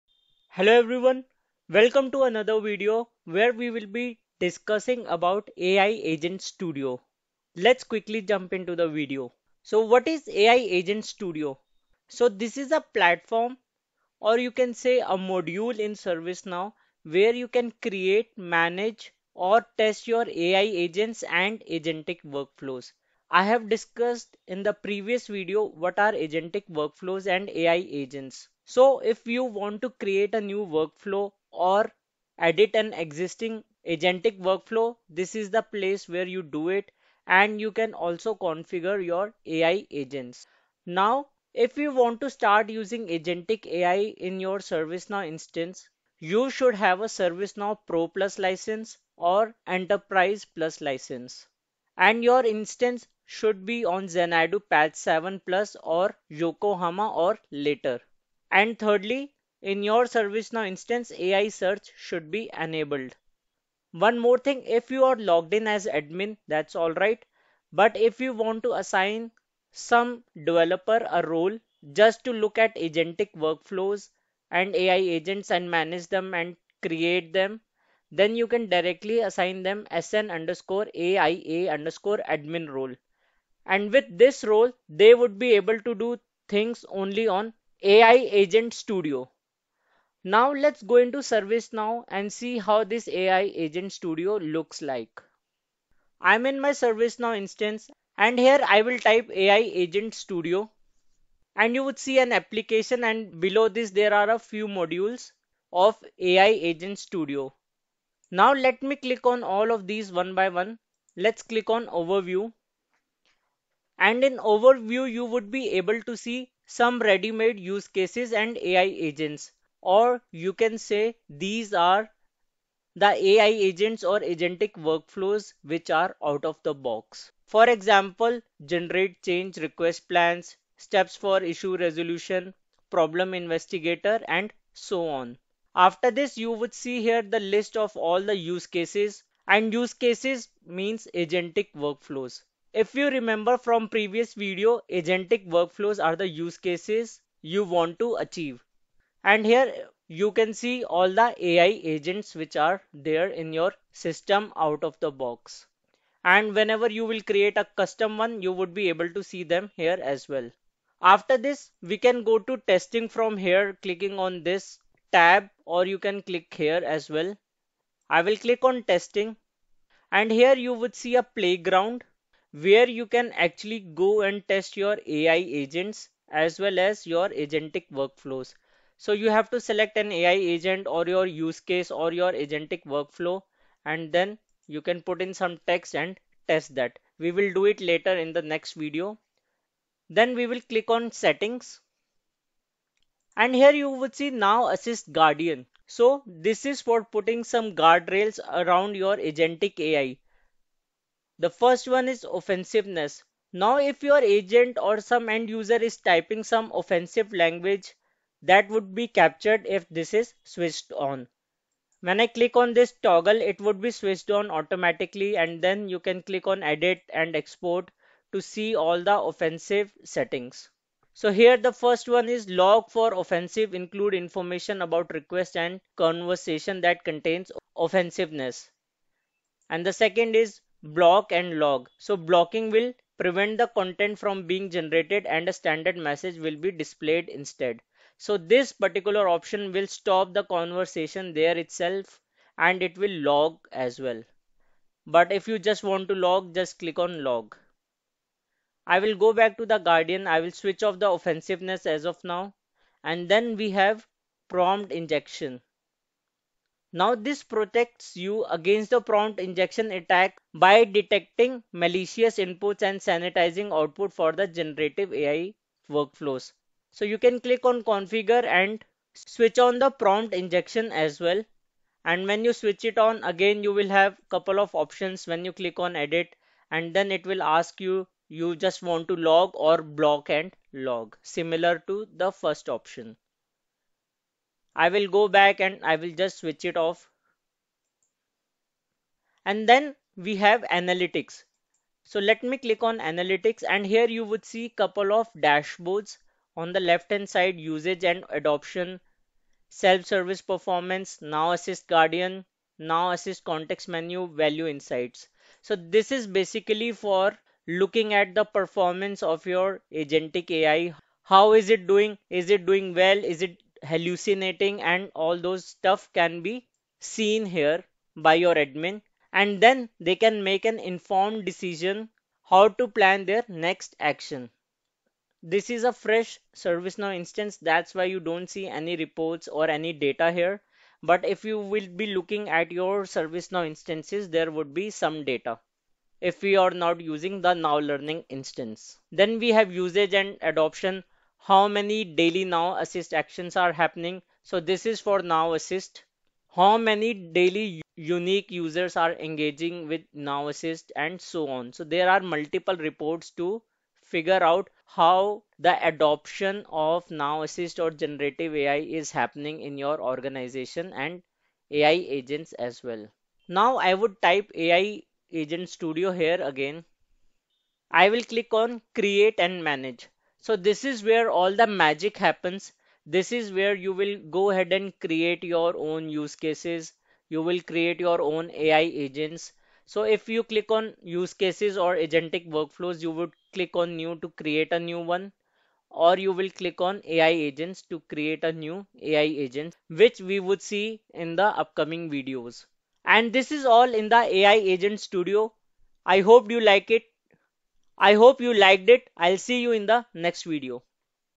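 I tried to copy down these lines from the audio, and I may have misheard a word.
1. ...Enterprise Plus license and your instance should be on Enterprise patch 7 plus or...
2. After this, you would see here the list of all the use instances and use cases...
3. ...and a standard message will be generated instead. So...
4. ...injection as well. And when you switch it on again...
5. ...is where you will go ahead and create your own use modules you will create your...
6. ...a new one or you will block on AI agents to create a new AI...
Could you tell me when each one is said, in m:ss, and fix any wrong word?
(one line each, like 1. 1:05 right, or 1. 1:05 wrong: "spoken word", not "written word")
1. 0:49 wrong: "Xanadu", not "Enterprise"
2. 2:15 wrong: "cases", not "instances"
3. 3:55 wrong: "displayed", not "generated"
4. 4:30 right
5. 6:13 wrong: "cases", not "modules"
6. 6:24 wrong: "click", not "block".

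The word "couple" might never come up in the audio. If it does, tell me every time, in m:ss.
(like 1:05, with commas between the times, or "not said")
4:34, 4:54.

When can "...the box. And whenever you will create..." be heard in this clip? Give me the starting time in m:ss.
2:34.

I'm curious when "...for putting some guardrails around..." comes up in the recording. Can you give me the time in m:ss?
3:16.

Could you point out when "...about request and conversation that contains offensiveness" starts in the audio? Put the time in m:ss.
3:44.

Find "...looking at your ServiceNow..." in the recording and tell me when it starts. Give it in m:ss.
5:32.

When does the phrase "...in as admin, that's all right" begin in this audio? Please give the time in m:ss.
1:05.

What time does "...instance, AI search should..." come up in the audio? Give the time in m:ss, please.
1:00.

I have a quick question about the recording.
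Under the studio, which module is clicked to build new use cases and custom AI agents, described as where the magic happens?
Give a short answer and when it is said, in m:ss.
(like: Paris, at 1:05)
Create and manage, at 6:08.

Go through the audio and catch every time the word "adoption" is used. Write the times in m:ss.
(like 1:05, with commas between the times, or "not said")
4:58, 5:40, 5:55.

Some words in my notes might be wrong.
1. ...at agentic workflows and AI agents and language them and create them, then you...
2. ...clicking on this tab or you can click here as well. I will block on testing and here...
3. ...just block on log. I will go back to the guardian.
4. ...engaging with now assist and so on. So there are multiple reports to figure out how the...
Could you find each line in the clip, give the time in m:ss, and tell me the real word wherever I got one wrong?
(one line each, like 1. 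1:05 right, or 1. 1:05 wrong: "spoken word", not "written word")
1. 1:12 wrong: "manage", not "language"
2. 2:43 wrong: "click", not "block"
3. 4:06 wrong: "click", not "block"
4. 5:49 right.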